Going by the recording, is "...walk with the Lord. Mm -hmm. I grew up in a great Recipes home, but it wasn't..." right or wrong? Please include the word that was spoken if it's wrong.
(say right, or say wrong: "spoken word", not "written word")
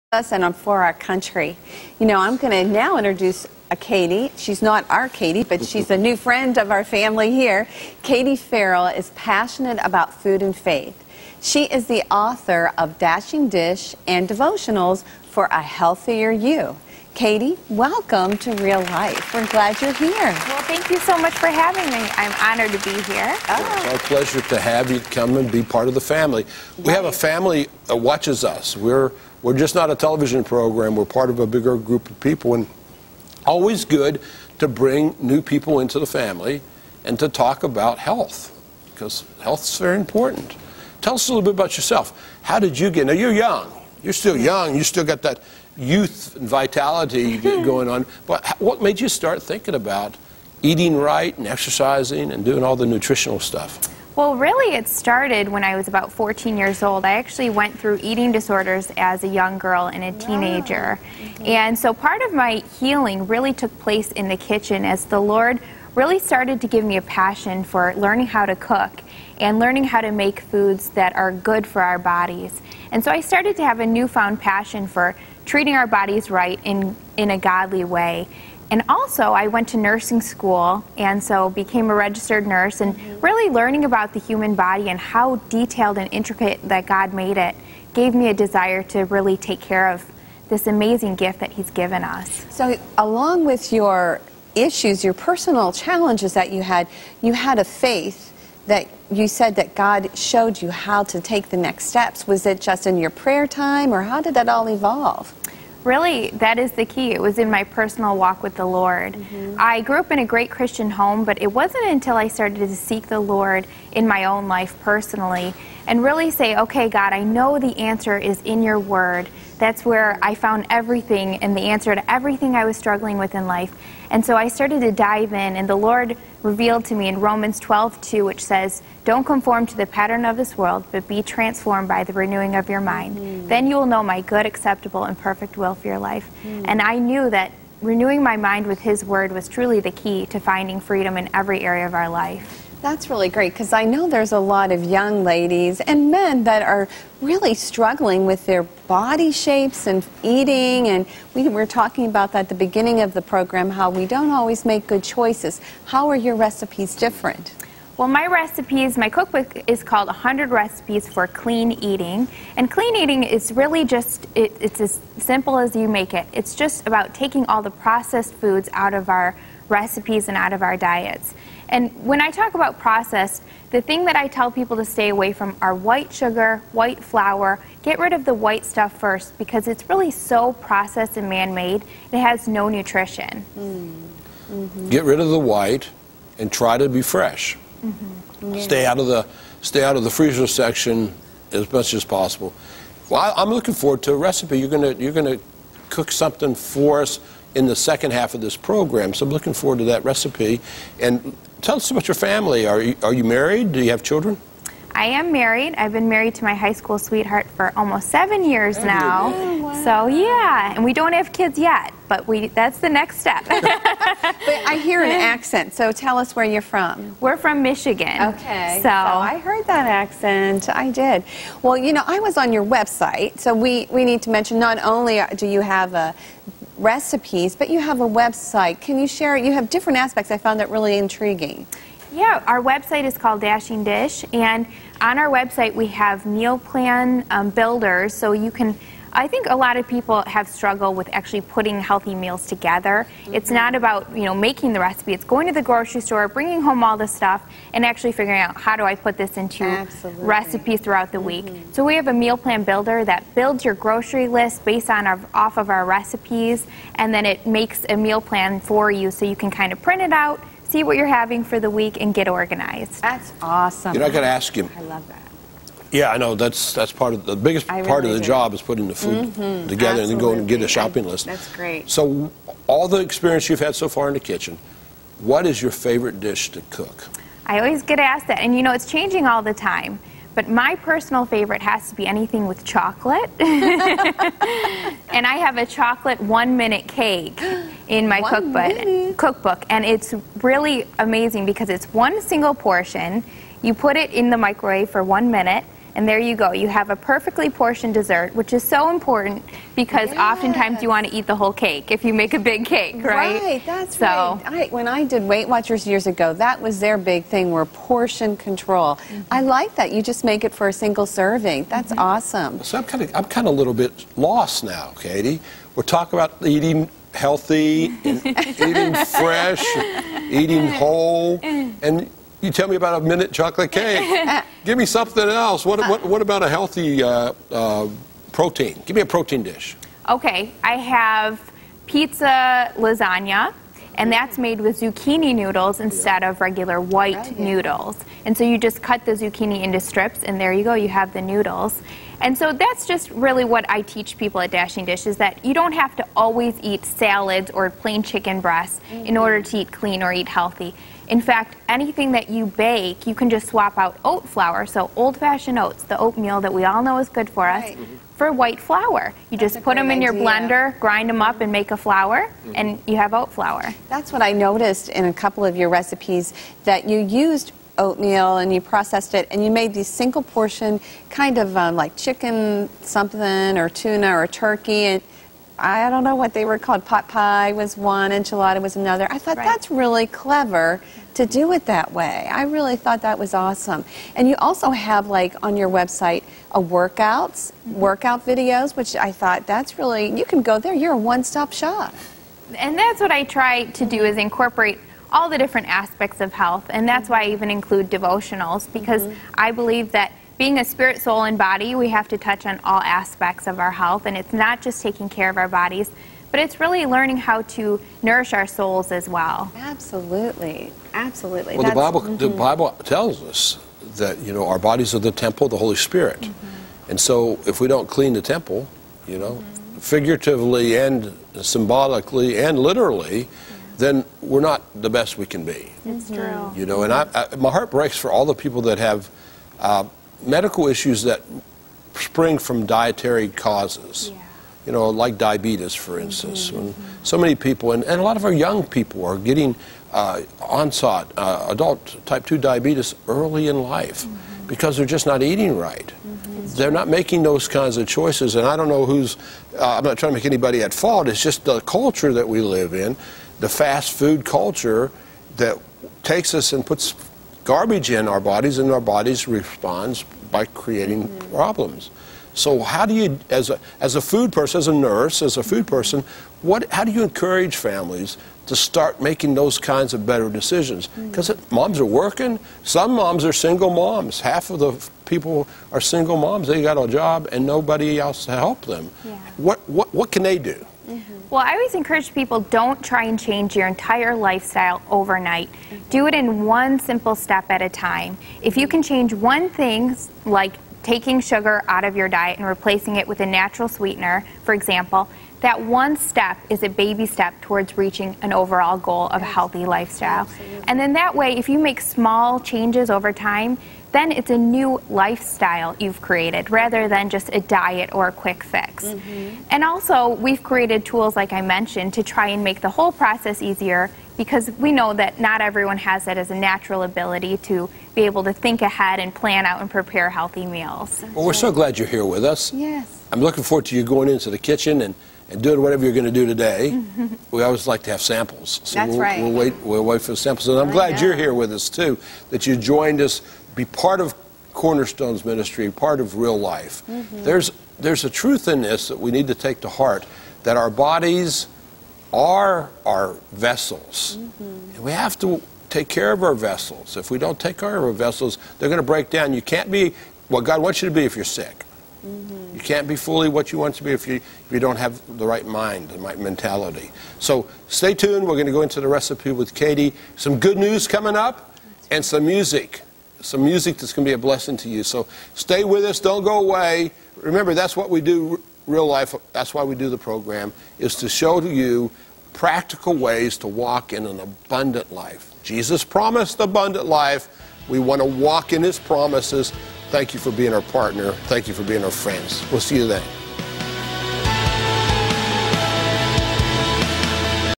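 wrong: "Christian", not "Recipes".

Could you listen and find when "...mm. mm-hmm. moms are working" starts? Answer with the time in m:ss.
7:51.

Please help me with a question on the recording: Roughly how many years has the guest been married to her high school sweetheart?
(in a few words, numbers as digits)
7.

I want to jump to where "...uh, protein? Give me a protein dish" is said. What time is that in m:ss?
5:27.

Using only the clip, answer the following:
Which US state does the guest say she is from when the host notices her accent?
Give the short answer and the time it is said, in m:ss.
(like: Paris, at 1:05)
Michigan, at 3:37.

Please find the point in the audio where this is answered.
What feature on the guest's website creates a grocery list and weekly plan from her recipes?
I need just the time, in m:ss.
4:12.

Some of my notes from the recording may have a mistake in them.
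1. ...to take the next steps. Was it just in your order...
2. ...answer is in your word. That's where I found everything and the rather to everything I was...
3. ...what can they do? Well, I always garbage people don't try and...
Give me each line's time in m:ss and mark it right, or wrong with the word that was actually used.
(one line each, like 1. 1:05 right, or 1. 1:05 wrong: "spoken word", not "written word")
1. 1:41 wrong: "prayer", not "order"
2. 1:57 wrong: "answer", not "rather"
3. 7:59 wrong: "encourage", not "garbage".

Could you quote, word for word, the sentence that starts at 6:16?
Pot pie was one, enchilada was another.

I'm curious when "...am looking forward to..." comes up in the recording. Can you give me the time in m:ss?
3:13.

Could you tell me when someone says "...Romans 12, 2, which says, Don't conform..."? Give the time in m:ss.
2:07.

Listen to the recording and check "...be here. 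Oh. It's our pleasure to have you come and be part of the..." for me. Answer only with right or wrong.
right.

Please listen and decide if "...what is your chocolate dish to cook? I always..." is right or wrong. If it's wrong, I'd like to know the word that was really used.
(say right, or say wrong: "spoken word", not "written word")
wrong: "favorite", not "chocolate".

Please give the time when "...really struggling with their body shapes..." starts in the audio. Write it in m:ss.
2:27.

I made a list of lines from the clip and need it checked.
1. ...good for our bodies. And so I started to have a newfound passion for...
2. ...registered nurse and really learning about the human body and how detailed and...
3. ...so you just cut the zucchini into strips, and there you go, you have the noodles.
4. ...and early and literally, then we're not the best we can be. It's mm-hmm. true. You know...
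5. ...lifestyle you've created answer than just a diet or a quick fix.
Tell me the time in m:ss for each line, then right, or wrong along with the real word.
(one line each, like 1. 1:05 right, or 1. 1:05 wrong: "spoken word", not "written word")
1. 1:11 right
2. 1:21 right
3. 5:38 right
4. 7:00 wrong: "symbolically", not "early"
5. 8:24 wrong: "rather", not "answer".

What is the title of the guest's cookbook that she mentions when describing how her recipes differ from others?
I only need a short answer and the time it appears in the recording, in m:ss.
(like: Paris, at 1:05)
100 Recipes for Clean Eating, at 2:40.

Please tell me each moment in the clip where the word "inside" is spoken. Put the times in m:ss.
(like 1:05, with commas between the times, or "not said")
not said.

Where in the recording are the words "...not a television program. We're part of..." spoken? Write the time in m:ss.
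0:29.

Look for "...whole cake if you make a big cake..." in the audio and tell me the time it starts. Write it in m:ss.
5:01.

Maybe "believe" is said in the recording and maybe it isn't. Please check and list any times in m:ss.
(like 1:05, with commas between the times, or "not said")
6:39.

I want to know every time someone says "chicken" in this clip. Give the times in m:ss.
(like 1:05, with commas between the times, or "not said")
5:48, 6:11.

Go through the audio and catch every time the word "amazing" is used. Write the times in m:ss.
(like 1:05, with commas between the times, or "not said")
1:30, 4:50.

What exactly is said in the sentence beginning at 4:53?
You put it in the microwave for one minute, and there you go.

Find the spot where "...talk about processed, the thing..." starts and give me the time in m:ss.
2:52.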